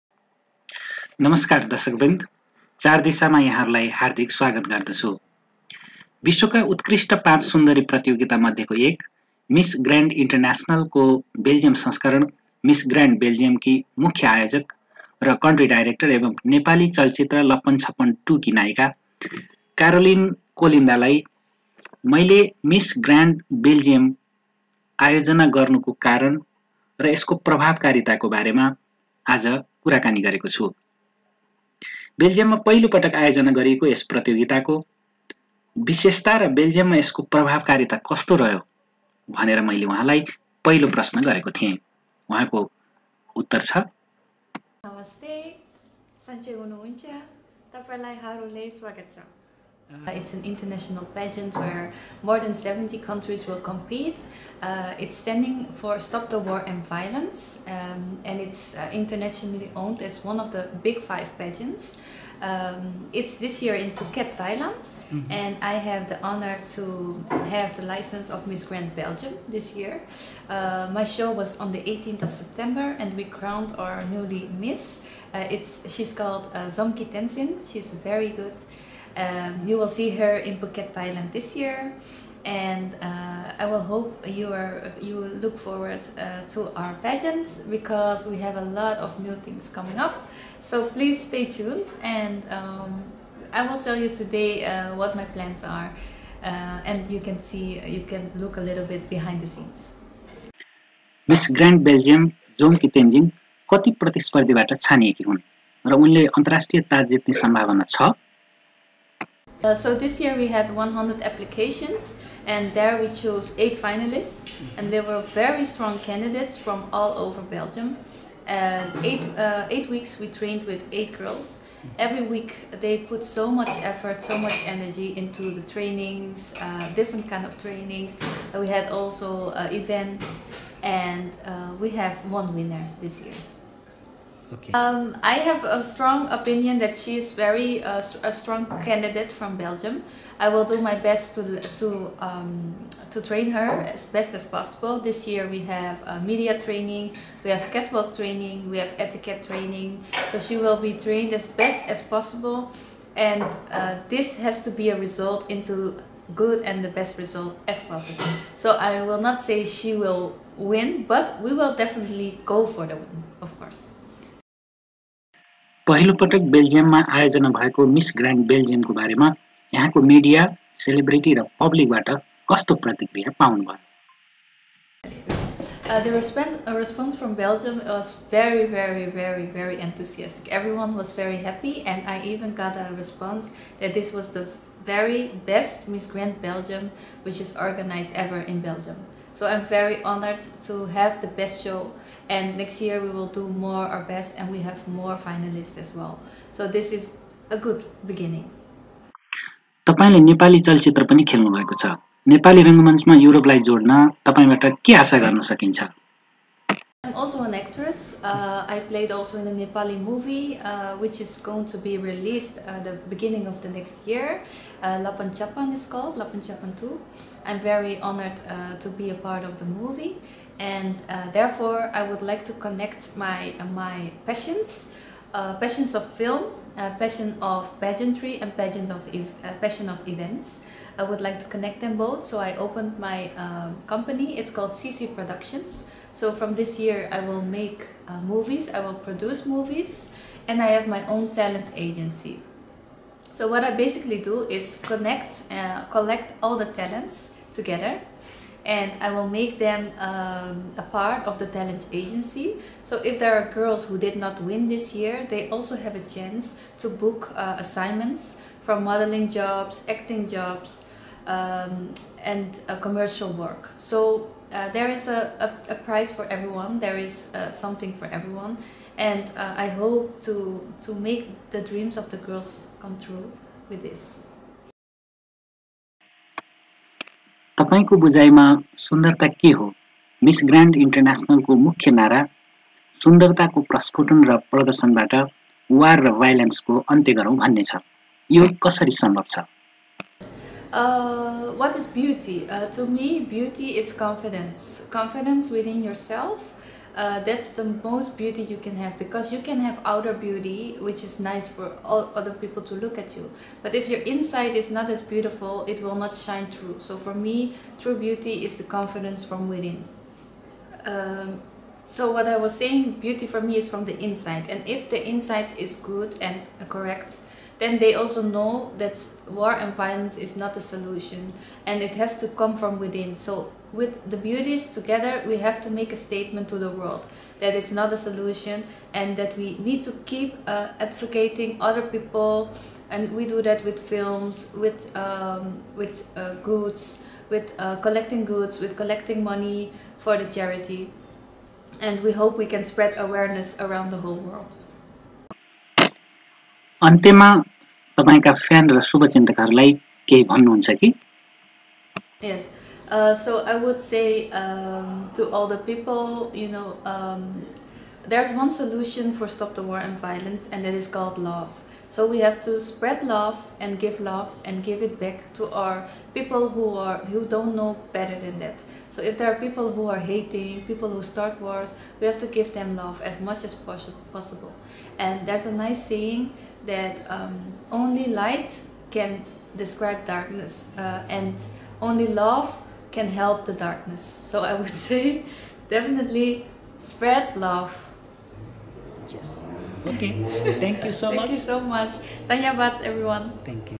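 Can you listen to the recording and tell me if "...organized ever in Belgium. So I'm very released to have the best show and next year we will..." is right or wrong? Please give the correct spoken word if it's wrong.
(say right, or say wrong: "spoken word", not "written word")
wrong: "honored", not "released".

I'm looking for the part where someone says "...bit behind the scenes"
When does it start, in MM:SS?
01:38.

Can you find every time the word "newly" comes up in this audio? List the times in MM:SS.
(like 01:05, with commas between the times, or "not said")
01:14.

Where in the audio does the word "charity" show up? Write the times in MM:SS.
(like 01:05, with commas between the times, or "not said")
05:40.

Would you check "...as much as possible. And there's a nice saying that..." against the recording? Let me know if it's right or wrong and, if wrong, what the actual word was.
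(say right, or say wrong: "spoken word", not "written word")
right.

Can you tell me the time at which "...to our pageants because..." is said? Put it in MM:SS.
01:26.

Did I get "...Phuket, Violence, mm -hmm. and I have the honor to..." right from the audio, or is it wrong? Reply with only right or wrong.
wrong.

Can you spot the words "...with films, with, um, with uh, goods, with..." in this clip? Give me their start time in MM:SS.
05:33.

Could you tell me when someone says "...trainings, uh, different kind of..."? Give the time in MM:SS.
02:05.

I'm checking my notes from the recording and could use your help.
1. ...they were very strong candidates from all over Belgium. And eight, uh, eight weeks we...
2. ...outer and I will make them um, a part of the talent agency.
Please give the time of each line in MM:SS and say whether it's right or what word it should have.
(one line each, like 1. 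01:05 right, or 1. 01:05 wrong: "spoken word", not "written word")
1. 01:54 right
2. 04:07 wrong: "together", not "outer".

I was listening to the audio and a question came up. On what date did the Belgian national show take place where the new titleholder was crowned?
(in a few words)
18th of September.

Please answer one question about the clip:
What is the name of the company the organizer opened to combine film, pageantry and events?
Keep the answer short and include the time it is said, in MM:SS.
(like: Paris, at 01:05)
CC Productions, at 03:54.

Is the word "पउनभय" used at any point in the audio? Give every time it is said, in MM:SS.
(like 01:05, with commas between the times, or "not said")
02:53.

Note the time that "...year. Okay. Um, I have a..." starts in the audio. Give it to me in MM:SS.
02:13.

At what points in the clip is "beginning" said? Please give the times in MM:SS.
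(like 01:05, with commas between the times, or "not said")
03:18, 03:33.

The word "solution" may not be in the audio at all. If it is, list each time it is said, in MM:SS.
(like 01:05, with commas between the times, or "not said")
05:20, 05:27, 05:58.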